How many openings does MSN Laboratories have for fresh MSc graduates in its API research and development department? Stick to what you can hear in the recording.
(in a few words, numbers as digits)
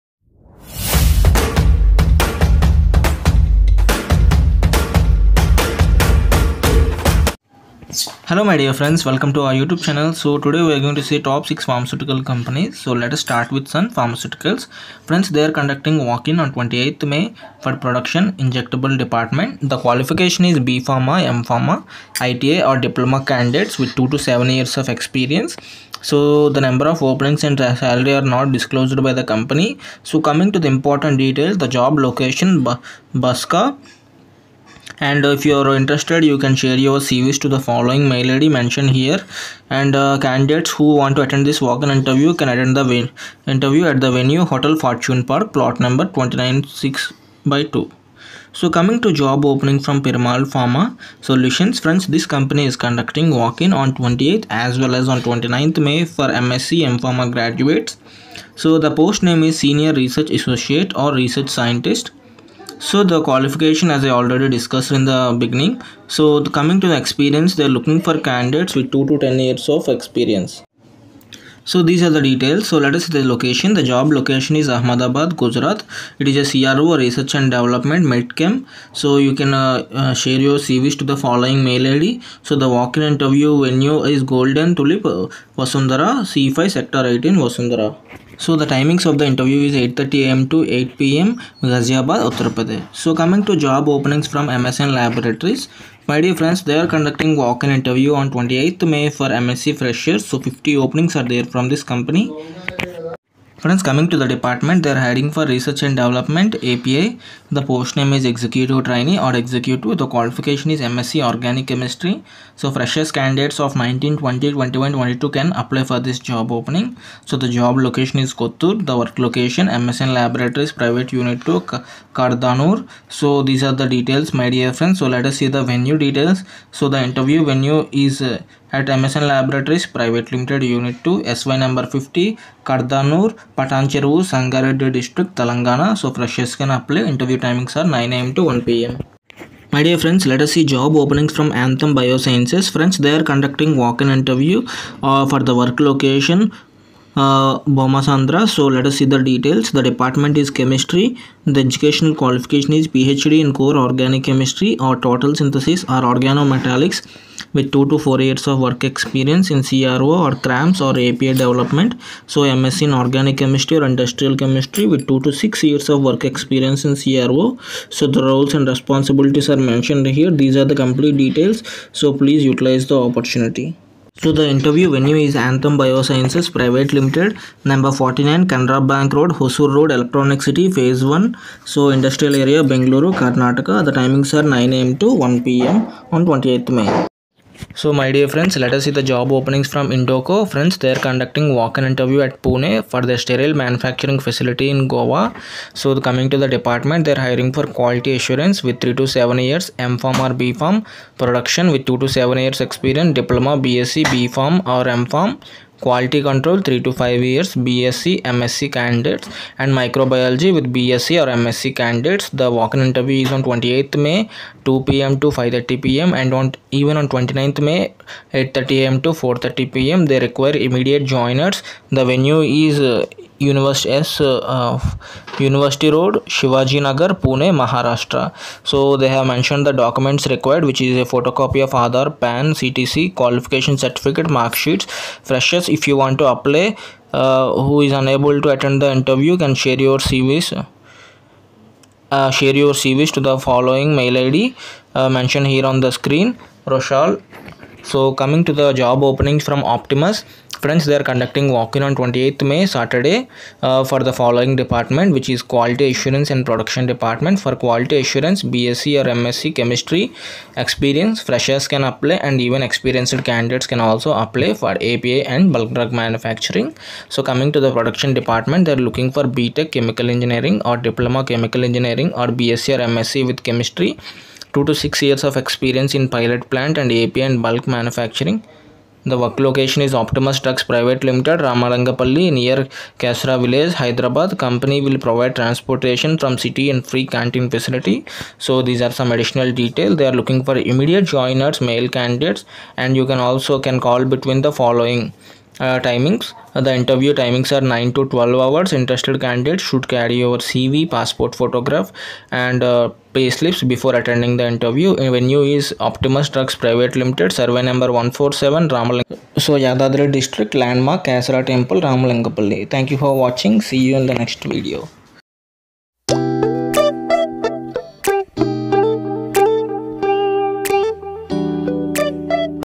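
50.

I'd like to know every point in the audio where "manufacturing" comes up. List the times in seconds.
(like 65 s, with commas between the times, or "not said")
193 s, 265 s, 277 s.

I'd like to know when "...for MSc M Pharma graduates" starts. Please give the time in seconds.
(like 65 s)
56 s.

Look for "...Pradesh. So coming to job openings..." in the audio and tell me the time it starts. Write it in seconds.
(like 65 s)
92 s.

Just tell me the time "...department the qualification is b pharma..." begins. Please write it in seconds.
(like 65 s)
19 s.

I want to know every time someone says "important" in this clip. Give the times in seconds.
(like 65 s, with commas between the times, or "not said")
30 s.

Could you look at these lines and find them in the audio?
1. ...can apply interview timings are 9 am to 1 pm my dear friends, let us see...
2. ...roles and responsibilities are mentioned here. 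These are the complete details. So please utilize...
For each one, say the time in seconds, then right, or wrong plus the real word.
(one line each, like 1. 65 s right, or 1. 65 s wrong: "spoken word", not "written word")
1. 136 s right
2. 168 s right.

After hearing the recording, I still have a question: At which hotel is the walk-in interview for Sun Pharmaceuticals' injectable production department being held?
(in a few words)
Hotel Fortune Park.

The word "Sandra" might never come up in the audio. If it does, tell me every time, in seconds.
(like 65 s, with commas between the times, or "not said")
148 s.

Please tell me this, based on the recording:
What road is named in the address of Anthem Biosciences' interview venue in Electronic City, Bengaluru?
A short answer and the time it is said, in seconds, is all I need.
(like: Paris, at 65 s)
Canara Bank Road, at 178 s.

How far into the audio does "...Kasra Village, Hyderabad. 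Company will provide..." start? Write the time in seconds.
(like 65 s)
282 s.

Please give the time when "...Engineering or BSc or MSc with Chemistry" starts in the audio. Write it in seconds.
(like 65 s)
271 s.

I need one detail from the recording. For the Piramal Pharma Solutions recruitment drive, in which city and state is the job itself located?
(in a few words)
Ahmedabad, Gujarat.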